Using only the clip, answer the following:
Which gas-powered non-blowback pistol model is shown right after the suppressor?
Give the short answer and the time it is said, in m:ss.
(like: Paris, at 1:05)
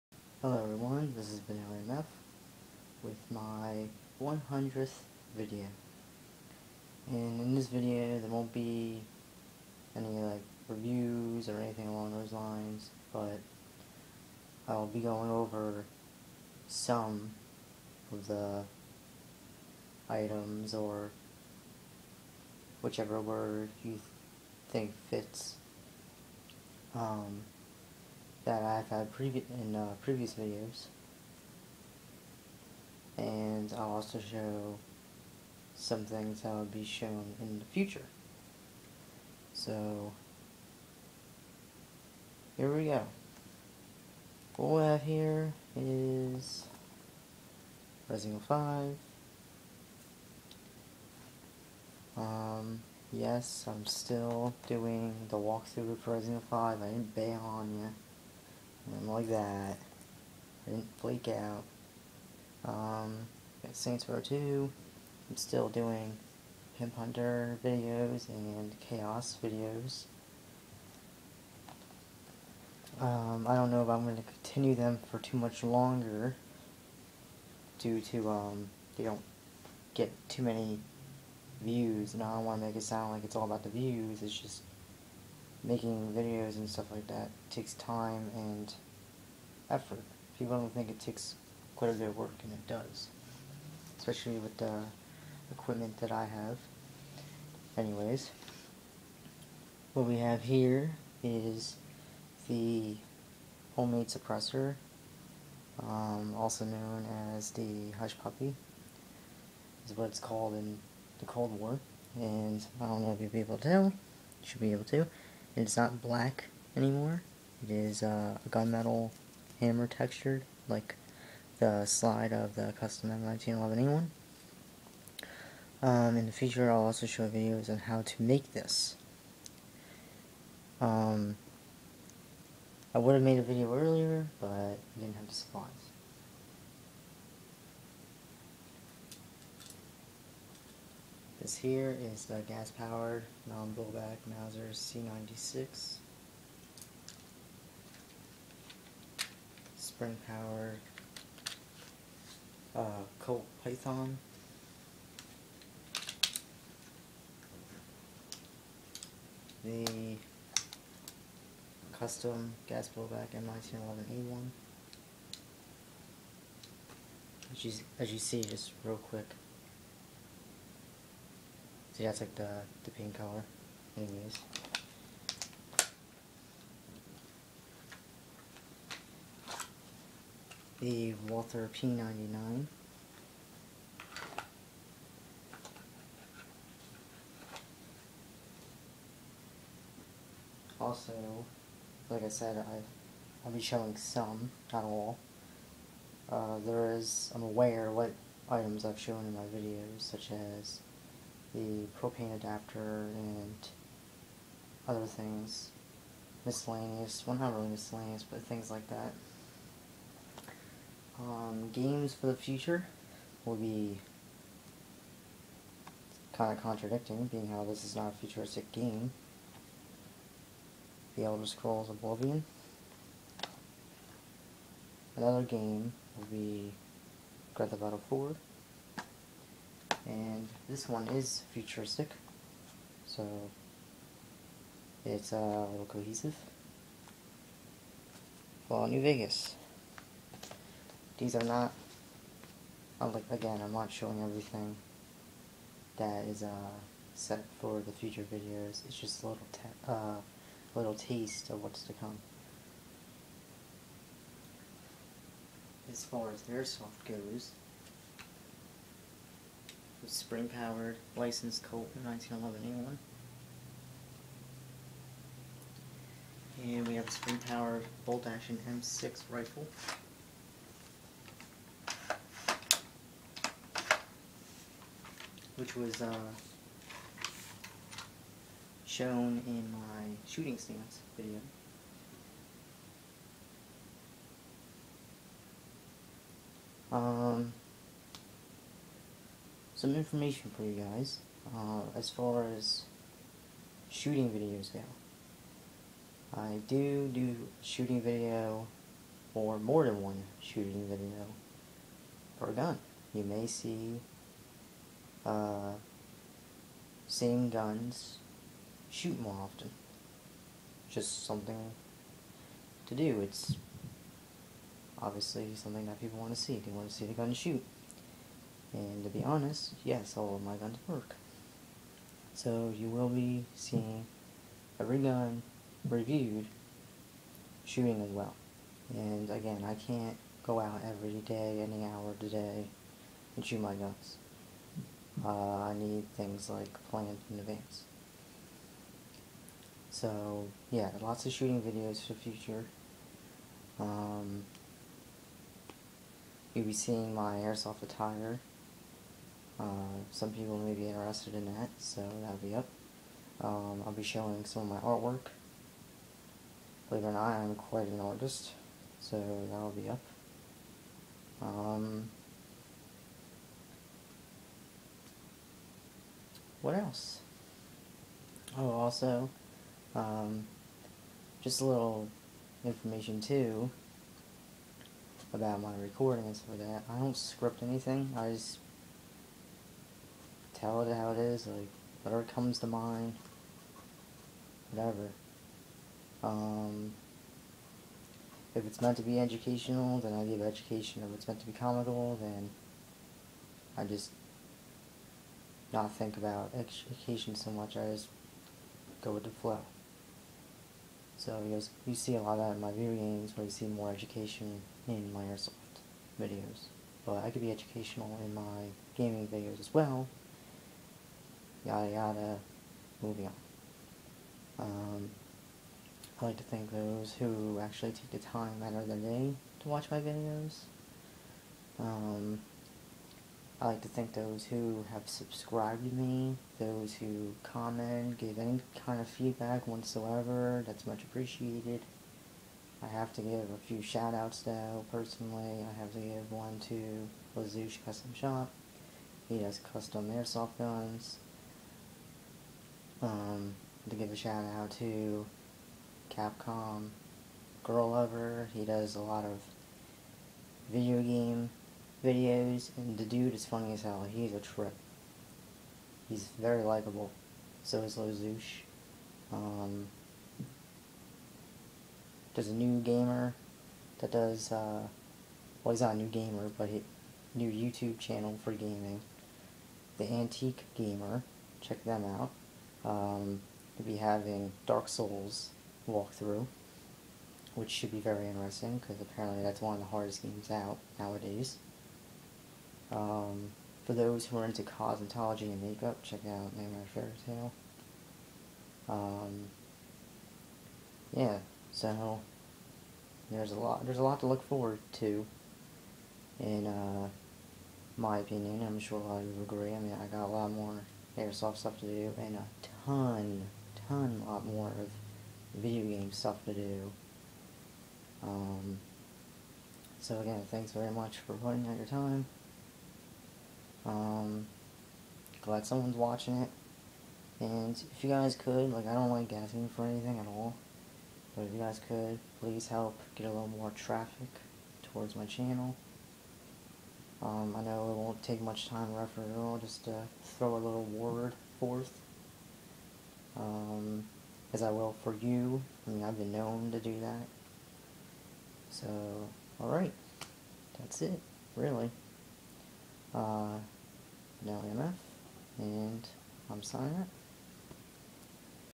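Mauser C96, at 2:24.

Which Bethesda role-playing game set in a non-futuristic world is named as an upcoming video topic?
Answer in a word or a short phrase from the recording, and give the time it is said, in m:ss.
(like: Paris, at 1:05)
The Elder Scrolls Oblivion, at 3:41.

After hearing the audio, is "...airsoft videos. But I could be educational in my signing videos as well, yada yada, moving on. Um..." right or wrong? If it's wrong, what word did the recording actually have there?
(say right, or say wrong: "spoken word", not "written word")
wrong: "gaming", not "signing".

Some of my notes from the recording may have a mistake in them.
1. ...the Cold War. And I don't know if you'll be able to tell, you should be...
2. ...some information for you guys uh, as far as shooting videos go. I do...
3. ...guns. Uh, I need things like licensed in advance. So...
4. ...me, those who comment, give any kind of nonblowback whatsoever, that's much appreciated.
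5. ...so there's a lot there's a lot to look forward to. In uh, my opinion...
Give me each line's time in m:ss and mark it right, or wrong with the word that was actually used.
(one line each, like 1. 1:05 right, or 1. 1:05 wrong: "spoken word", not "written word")
1. 1:51 right
2. 4:49 right
3. 5:33 wrong: "planned", not "licensed"
4. 7:05 wrong: "feedback", not "nonblowback"
5. 8:11 right.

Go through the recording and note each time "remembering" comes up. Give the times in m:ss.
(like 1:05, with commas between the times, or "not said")
not said.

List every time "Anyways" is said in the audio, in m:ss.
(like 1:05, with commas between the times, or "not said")
1:37, 2:53.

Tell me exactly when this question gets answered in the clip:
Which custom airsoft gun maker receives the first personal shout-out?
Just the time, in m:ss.
7:17.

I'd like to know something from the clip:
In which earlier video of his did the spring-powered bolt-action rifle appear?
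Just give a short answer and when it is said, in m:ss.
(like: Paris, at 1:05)
shooting stance video, at 4:40.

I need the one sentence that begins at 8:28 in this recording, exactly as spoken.
Um, so again, thanks very much for putting out your time.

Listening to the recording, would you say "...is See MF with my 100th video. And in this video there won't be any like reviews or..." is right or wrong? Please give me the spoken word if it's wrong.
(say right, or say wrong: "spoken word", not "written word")
wrong: "Benelli", not "See".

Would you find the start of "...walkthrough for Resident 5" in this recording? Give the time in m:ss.
0:55.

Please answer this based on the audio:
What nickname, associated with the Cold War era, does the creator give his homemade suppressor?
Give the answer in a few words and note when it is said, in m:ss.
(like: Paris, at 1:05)
Hush Puppy, at 1:47.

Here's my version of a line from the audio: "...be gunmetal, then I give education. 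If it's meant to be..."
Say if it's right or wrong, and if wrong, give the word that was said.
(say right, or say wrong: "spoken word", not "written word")
wrong: "educational", not "gunmetal".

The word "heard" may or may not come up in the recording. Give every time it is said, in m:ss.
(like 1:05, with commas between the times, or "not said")
not said.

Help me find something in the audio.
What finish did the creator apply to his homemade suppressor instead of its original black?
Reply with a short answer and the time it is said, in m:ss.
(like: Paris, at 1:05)
gunmetal hammer textured, at 1:58.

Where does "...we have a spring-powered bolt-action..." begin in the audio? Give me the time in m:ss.
4:26.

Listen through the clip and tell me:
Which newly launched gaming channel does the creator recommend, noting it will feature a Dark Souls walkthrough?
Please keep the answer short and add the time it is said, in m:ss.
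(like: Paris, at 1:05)
The Antique Gamer, at 7:49.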